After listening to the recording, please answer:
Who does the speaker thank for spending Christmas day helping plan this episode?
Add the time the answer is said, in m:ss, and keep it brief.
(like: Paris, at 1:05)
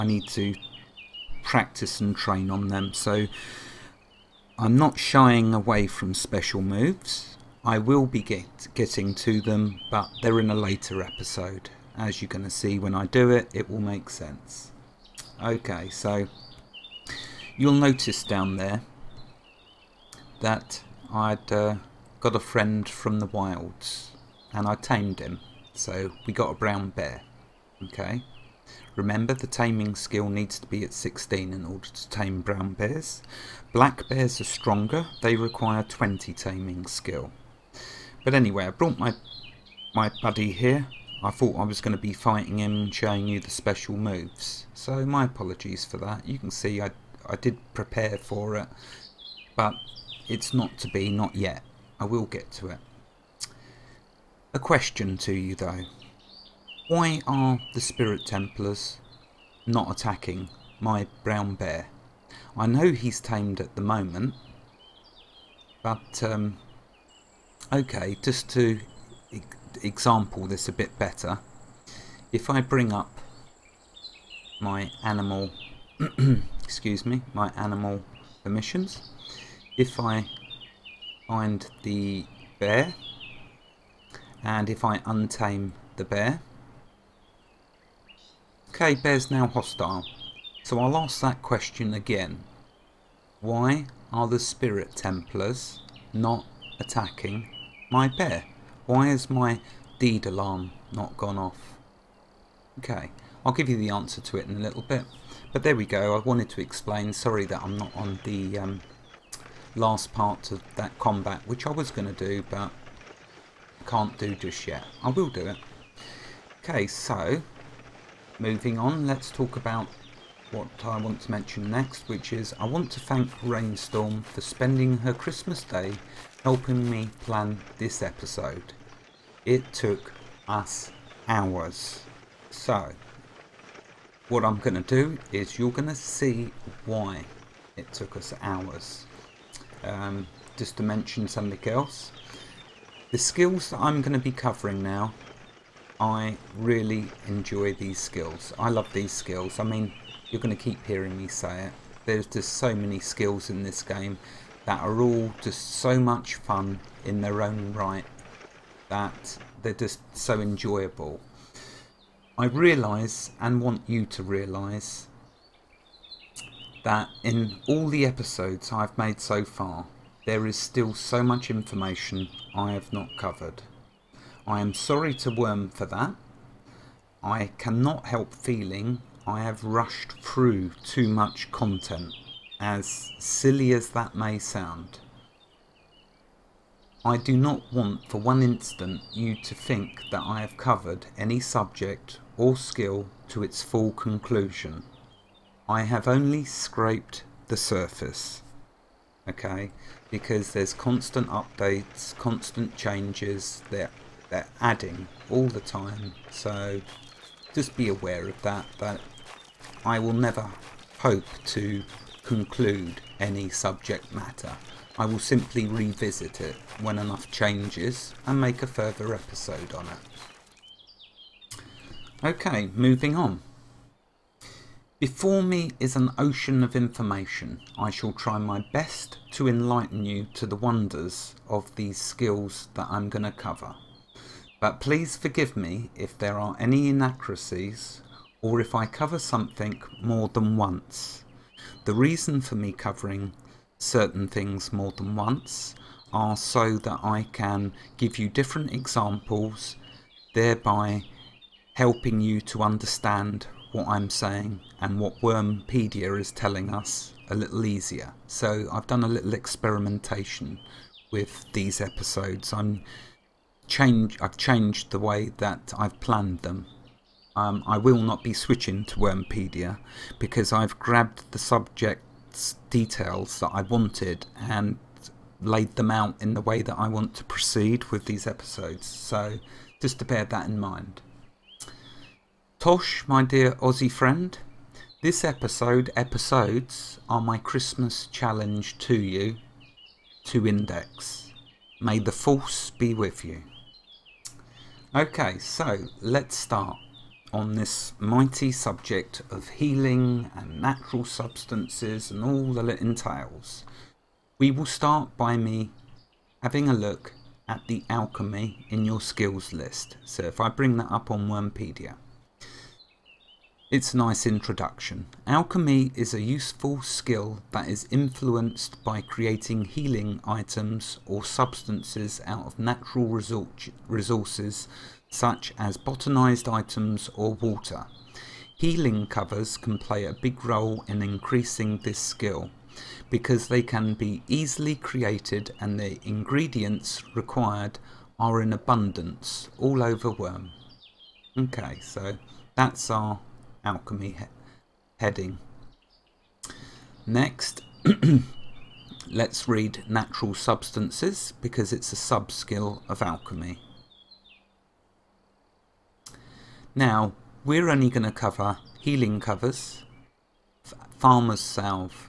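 Raynstorm, at 2:03.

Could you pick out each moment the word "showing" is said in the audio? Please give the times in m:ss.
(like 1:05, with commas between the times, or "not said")
0:42.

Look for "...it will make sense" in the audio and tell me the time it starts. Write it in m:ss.
0:13.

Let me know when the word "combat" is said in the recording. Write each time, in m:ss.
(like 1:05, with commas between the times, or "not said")
1:50.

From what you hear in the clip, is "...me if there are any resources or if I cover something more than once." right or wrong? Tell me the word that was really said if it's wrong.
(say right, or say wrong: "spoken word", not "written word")
wrong: "inaccuracies", not "resources".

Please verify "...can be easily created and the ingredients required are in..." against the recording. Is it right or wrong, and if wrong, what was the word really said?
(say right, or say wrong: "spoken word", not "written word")
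right.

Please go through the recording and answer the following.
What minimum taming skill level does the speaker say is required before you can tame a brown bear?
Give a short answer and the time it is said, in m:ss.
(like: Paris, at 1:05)
16, at 0:30.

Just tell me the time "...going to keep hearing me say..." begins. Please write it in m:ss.
2:30.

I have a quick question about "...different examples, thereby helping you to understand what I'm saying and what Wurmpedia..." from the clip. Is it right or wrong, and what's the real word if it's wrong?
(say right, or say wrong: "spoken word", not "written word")
right.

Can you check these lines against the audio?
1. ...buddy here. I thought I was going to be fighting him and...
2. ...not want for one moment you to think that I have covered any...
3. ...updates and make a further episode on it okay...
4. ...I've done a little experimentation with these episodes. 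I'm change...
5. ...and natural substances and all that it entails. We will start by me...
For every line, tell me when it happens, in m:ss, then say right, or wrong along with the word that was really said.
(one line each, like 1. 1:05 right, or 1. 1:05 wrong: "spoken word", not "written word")
1. 0:40 right
2. 3:07 wrong: "instant", not "moment"
3. 3:37 wrong: "changes", not "updates"
4. 4:18 right
5. 5:00 right.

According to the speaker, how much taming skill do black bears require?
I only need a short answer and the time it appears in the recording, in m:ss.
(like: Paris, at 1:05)
20, at 0:35.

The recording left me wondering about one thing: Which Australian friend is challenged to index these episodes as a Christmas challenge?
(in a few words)
Tosh.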